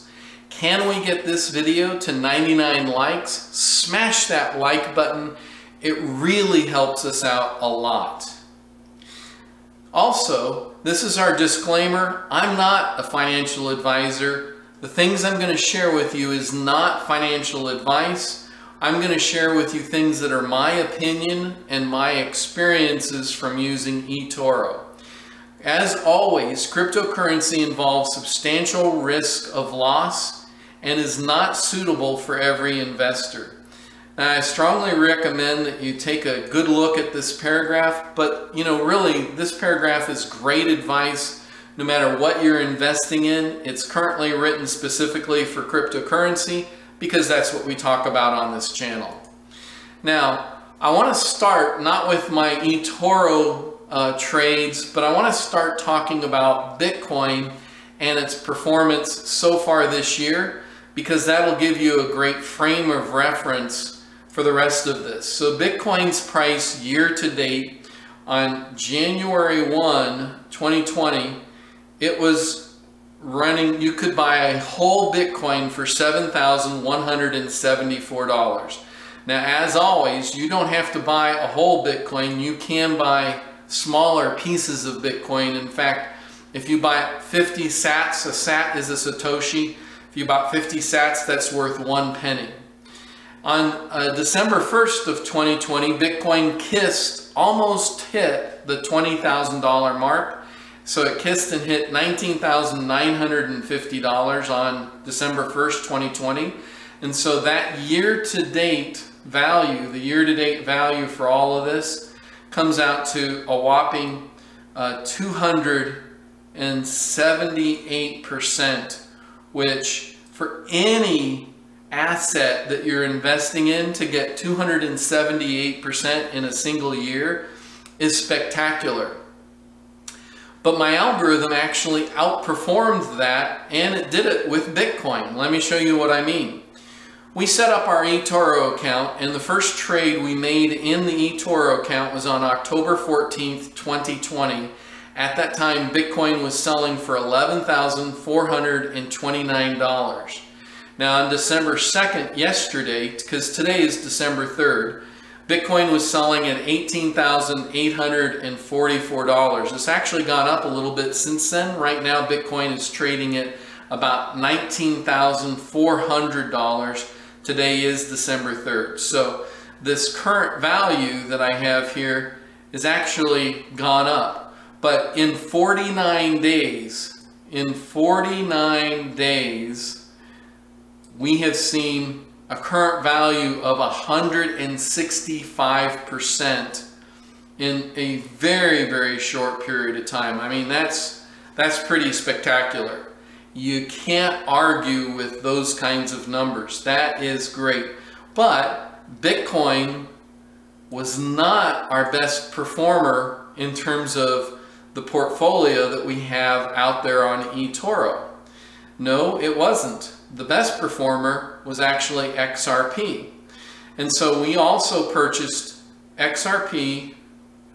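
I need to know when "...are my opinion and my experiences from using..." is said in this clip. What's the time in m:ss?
0:20.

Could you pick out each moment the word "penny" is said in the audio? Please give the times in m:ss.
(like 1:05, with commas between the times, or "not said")
1:32.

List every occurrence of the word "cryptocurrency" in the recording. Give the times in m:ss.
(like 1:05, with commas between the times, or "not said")
0:26, 0:45.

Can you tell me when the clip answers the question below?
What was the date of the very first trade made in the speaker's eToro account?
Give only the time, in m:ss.
2:22.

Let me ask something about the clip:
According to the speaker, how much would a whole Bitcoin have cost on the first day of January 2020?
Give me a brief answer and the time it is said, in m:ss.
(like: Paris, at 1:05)
$7,174, at 1:15.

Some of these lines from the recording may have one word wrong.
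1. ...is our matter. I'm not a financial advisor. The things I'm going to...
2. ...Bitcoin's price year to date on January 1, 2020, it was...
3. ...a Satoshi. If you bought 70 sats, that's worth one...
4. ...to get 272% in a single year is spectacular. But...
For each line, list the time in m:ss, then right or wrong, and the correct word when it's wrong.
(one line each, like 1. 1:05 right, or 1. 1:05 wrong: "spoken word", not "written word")
1. 0:11 wrong: "disclaimer", not "matter"
2. 1:05 right
3. 1:28 wrong: "50", not "70"
4. 2:03 wrong: "278", not "272".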